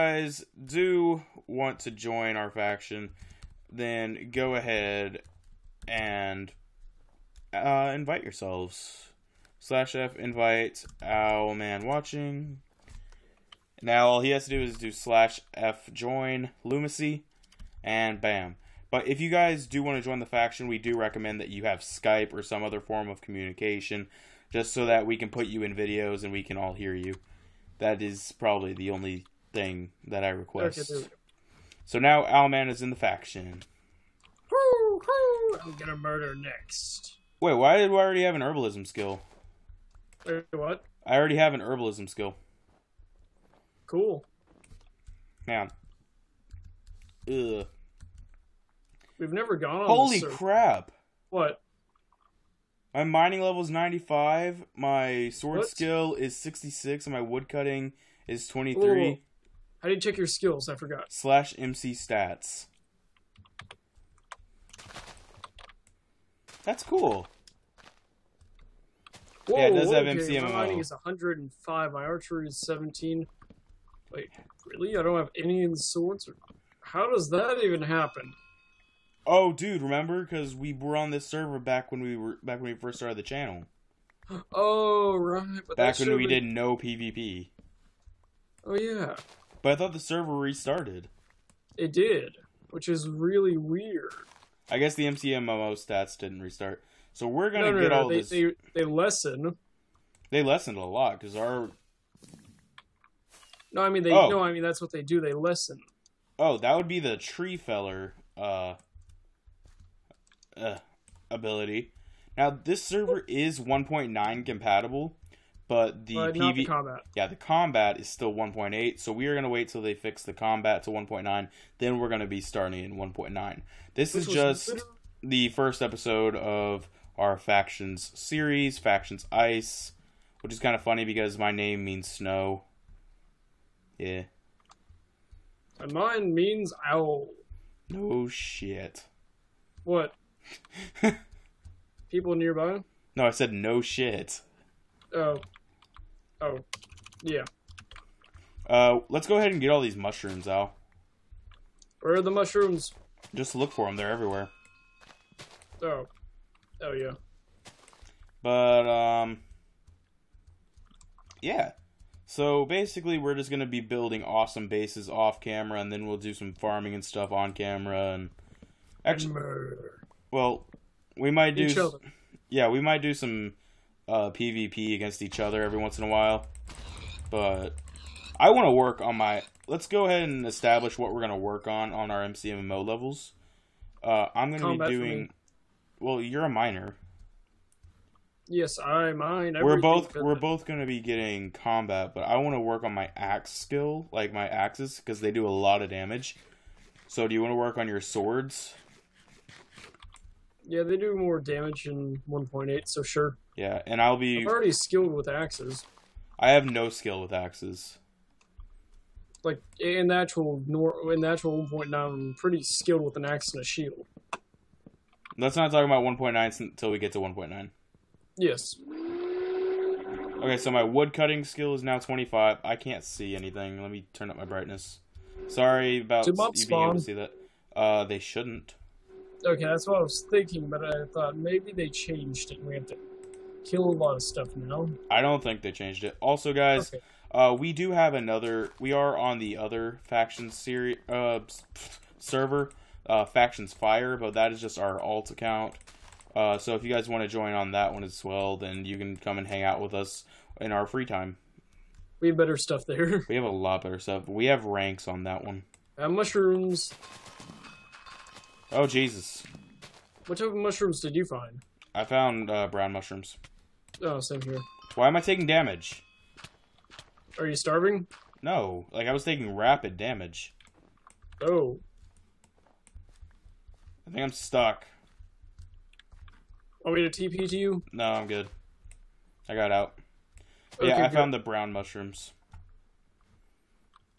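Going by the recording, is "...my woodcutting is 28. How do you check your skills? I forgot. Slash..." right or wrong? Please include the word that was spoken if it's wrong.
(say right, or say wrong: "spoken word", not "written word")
wrong: "23", not "28".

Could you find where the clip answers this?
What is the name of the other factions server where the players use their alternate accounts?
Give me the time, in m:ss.
4:03.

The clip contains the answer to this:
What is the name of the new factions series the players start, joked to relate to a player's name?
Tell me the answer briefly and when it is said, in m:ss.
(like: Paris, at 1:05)
Factions Ice, at 2:08.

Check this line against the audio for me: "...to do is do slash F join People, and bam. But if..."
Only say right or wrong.
wrong.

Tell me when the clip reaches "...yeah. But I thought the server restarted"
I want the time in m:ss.
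1:28.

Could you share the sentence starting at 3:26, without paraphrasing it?
I have no skill with axes.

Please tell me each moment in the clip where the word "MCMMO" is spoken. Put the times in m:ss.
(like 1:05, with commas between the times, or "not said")
1:35, 3:02.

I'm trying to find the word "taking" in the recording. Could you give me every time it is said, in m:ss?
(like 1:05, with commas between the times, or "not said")
4:25, 4:29.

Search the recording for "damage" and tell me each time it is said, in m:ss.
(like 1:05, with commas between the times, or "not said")
3:15, 3:21, 4:25, 4:29.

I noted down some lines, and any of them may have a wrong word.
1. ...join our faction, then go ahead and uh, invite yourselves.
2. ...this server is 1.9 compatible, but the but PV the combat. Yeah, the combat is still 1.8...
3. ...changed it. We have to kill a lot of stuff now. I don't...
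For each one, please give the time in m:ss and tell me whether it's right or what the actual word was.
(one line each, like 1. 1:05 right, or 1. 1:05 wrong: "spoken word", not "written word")
1. 0:01 right
2. 1:52 right
3. 3:51 right.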